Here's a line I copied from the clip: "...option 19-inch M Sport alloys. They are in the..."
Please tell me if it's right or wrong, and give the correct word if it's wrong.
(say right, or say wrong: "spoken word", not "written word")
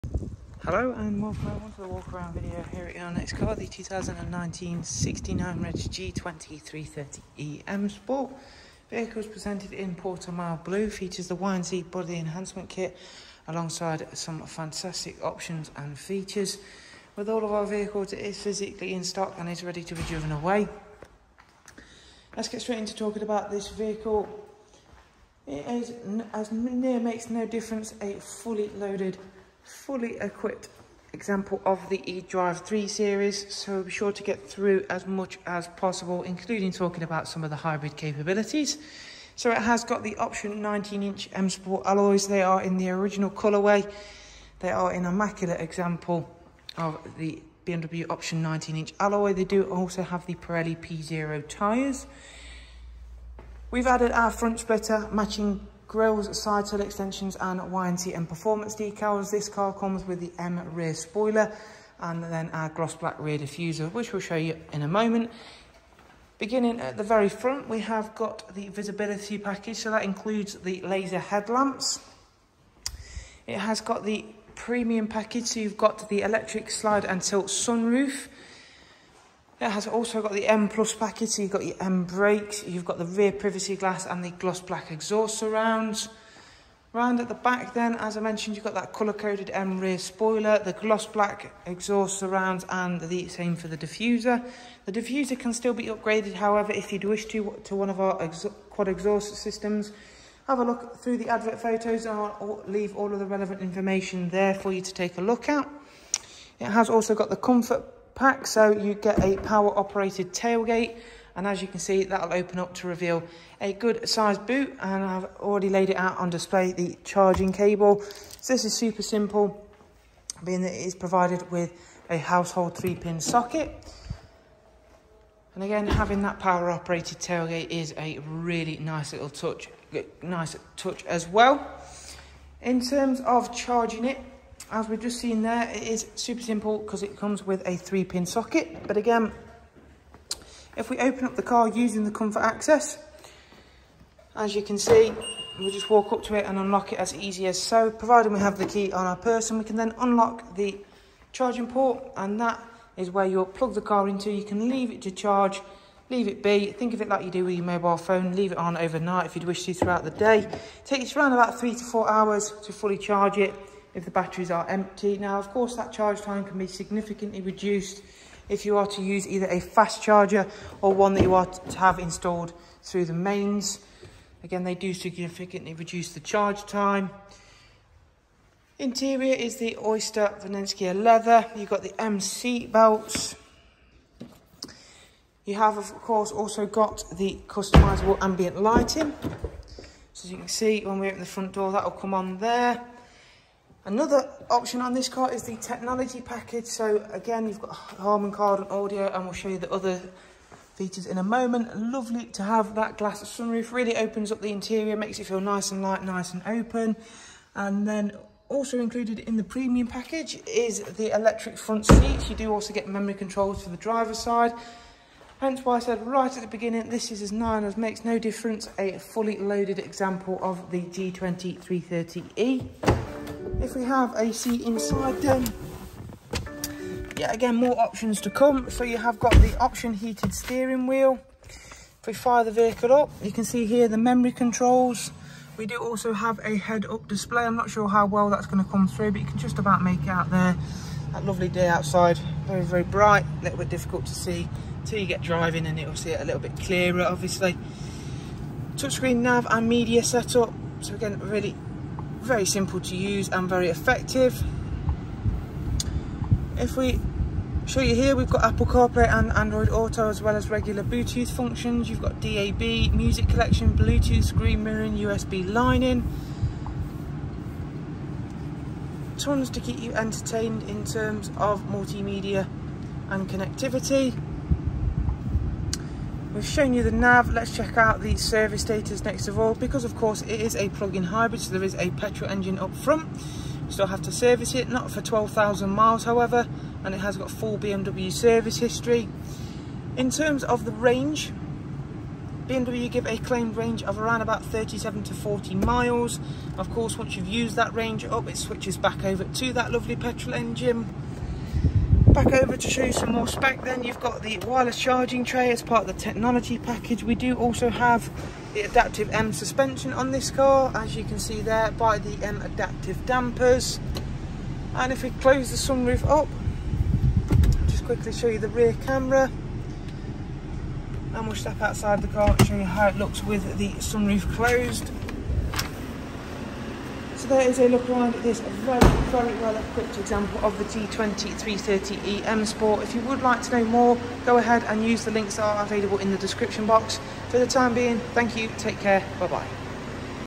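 right.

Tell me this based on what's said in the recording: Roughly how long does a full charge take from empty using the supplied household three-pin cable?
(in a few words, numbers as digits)
3 to 4 hours.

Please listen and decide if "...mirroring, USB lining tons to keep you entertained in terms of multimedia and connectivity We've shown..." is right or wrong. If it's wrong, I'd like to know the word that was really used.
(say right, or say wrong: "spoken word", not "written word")
right.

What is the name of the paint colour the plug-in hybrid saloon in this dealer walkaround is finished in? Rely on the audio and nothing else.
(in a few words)
Portimao Blue.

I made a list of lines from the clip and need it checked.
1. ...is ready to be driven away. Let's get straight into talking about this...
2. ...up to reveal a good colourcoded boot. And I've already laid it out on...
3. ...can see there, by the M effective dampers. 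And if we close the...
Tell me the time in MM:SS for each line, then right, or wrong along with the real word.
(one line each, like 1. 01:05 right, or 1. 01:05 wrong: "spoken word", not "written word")
1. 00:19 right
2. 01:52 wrong: "sized", not "colourcoded"
3. 05:11 wrong: "adaptive", not "effective".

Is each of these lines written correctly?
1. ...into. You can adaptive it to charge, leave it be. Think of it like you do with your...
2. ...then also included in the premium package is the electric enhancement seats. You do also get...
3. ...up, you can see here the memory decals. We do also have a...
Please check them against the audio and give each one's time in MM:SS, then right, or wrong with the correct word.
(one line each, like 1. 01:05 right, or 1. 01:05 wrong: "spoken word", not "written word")
1. 02:34 wrong: "leave", not "adaptive"
2. 03:27 wrong: "front", not "enhancement"
3. 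03:52 wrong: "controls", not "decals".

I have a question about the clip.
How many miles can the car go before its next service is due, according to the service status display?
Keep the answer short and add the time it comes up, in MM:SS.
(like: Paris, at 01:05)
12,000 miles, at 04:45.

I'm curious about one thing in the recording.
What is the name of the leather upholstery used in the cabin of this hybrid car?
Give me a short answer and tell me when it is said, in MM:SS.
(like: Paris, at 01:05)
Oyster Vernasca, at 02:59.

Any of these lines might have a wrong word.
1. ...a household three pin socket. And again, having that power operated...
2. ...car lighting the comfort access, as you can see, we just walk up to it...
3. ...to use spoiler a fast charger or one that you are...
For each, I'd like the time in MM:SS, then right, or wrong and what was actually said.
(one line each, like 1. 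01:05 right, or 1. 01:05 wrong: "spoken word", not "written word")
1. 02:02 right
2. 02:21 wrong: "using", not "lighting"
3. 02:48 wrong: "either", not "spoiler".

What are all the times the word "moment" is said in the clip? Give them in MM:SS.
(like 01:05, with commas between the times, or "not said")
01:04, 03:21.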